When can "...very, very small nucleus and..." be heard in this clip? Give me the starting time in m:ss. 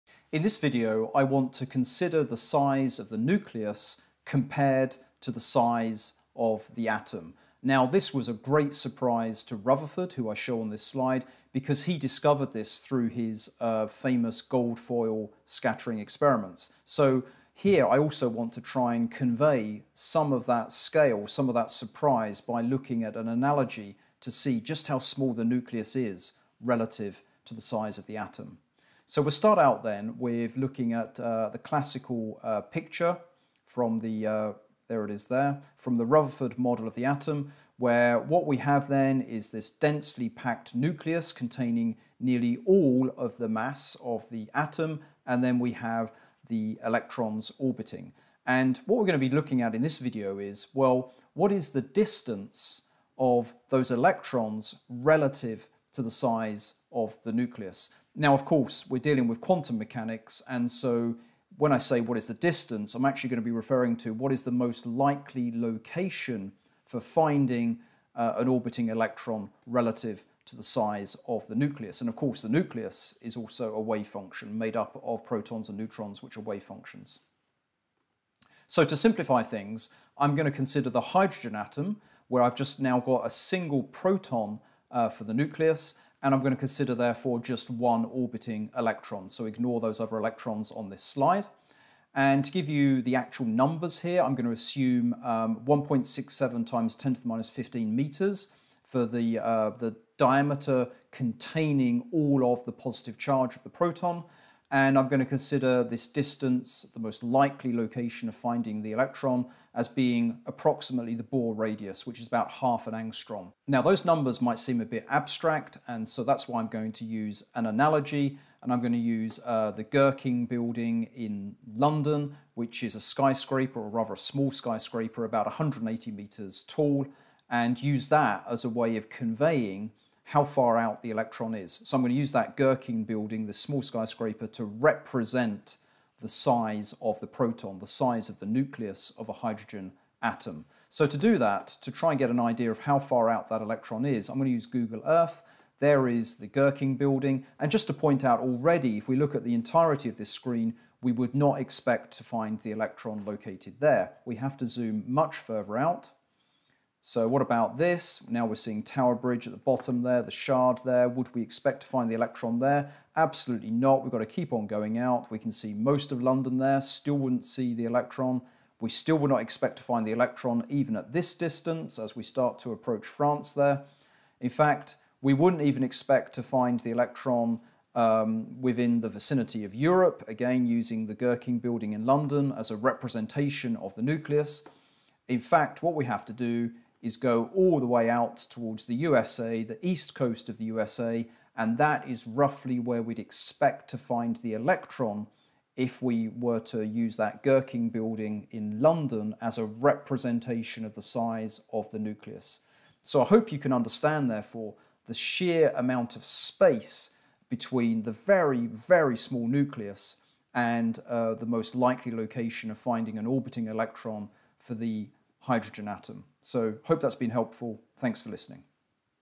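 3:28.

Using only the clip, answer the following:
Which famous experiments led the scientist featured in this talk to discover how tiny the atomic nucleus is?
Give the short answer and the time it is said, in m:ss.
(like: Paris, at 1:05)
Gold foil scattering experiments, at 0:14.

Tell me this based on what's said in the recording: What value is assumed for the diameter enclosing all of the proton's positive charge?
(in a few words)
1.67 x 10^-15 meters.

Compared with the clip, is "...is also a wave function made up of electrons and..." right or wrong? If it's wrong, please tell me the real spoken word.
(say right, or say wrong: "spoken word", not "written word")
wrong: "protons", not "electrons".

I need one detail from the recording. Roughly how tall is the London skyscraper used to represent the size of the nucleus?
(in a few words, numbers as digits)
180 metres.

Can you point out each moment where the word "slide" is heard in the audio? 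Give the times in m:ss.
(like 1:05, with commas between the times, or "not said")
0:10, 1:31.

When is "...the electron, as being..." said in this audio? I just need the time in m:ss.
1:48.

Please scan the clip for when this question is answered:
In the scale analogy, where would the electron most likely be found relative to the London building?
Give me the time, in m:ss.
3:09.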